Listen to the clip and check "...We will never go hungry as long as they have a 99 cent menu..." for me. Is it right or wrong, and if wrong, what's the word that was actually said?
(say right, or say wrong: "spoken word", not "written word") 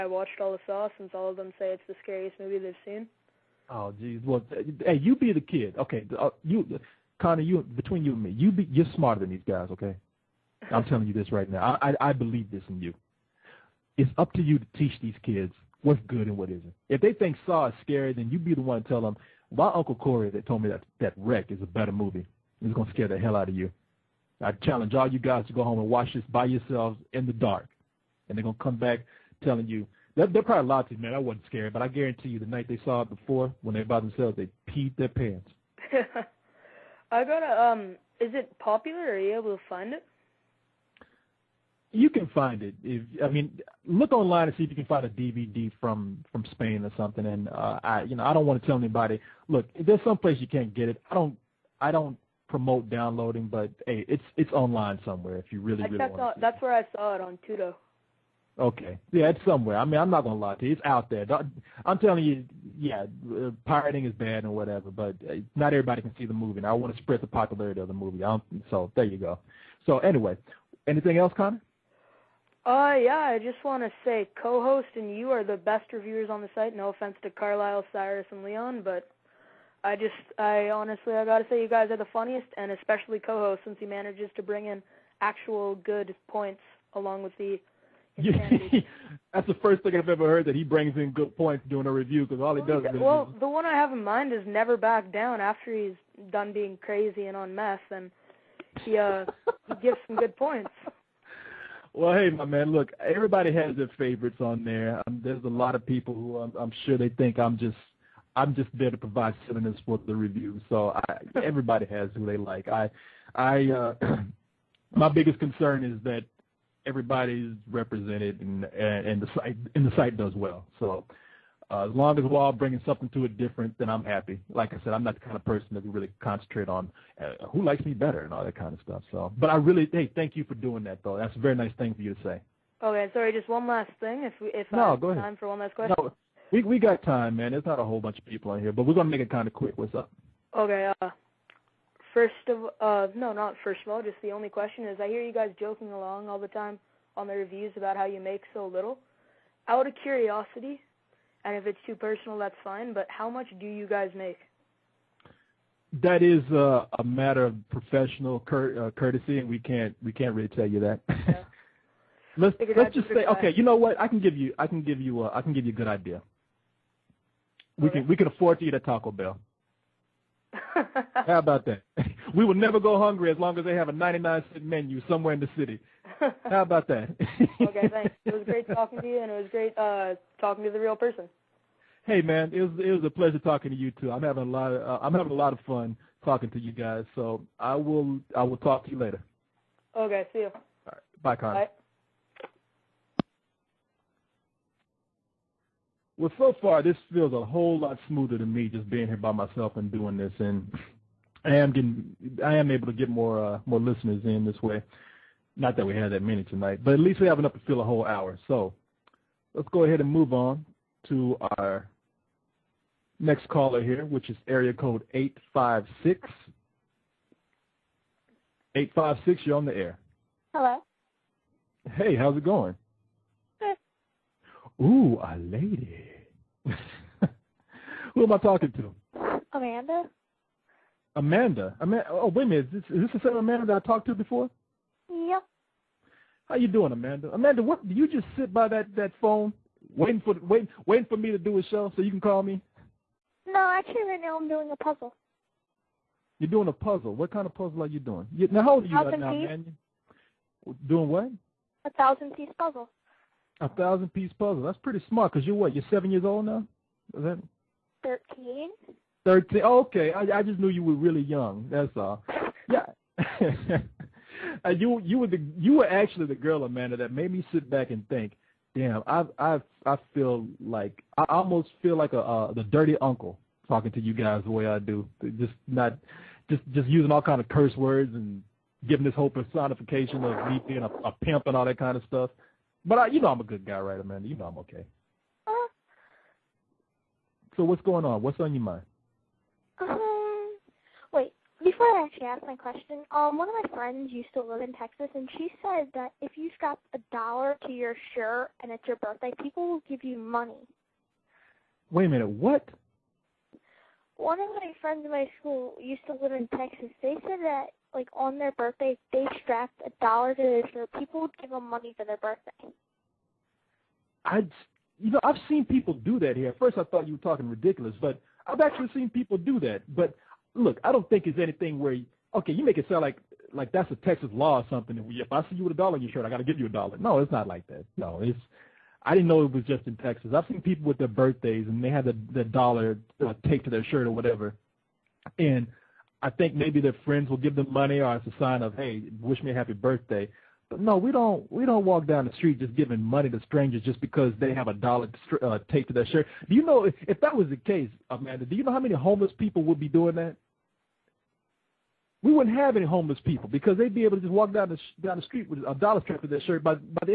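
right.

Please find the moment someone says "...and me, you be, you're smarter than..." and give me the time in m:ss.
0:08.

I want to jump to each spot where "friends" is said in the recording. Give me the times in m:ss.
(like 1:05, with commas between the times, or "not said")
4:53, 5:04, 5:37.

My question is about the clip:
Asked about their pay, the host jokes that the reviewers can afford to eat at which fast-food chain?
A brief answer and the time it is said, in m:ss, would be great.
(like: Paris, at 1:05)
Taco Bell, at 2:48.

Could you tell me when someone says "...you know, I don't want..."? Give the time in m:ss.
0:48.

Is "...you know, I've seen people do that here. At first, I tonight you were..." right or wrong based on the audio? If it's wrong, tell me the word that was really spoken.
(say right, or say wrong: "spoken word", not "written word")
wrong: "thought", not "tonight".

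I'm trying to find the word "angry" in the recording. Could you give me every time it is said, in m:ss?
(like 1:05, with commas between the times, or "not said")
not said.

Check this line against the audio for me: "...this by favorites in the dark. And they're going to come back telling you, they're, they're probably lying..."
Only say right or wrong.
wrong.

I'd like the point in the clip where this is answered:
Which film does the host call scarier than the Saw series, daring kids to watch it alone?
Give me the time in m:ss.
0:21.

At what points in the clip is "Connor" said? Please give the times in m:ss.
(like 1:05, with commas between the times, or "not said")
0:07, 1:11, 3:11.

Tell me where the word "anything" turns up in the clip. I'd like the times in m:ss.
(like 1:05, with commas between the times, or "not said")
1:10, 5:21.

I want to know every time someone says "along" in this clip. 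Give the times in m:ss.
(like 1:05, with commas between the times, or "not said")
1:26, 2:25.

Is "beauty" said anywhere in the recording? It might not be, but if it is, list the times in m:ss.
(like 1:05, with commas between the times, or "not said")
not said.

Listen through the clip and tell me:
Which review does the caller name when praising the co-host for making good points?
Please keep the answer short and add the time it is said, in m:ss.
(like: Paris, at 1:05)
Never Back Down, at 1:34.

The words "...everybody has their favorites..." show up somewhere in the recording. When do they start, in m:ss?
1:42.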